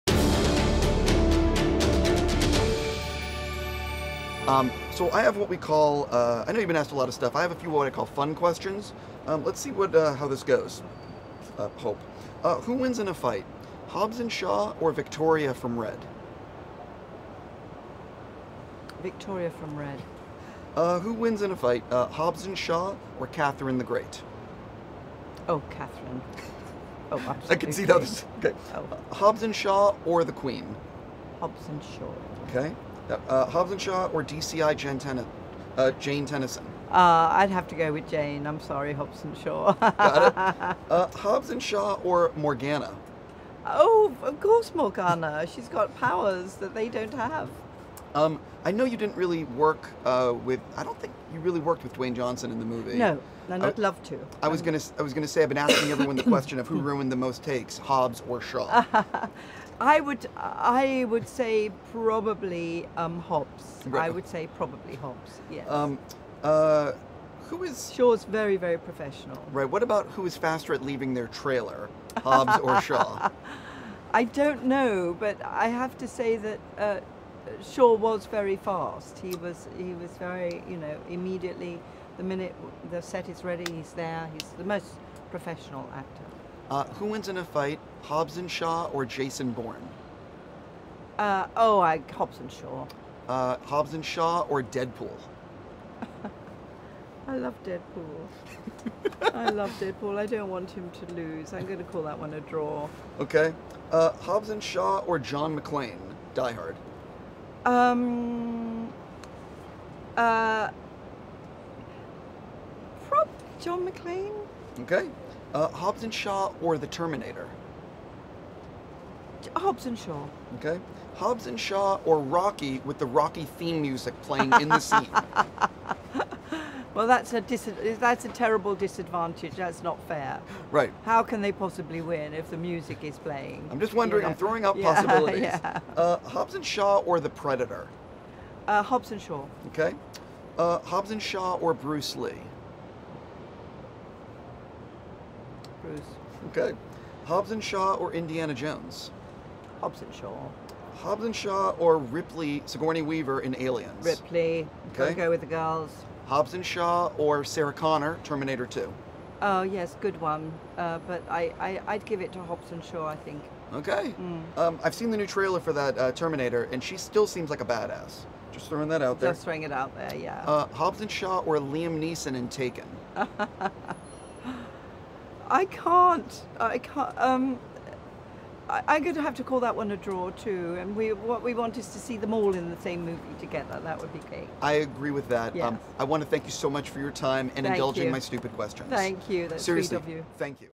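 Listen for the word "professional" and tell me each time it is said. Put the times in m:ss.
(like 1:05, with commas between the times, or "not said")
1:08, 1:25.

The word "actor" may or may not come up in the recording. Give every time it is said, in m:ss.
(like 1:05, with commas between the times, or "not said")
1:25.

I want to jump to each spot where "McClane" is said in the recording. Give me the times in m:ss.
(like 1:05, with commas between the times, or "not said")
1:45, 1:53.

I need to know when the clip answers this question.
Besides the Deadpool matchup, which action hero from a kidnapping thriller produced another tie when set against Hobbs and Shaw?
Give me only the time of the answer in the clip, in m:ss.
2:51.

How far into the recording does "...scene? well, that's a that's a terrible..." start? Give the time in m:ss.
2:04.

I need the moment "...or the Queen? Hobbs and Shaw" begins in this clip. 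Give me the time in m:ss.
0:30.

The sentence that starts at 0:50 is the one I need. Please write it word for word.
I don't think you really worked with Dwayne Johnson in the movie.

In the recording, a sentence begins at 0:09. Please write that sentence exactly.
Um, let's see what uh, how this goes.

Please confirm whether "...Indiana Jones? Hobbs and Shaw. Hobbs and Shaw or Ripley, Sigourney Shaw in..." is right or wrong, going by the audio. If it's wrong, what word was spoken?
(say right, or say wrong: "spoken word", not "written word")
wrong: "Weaver", not "Shaw".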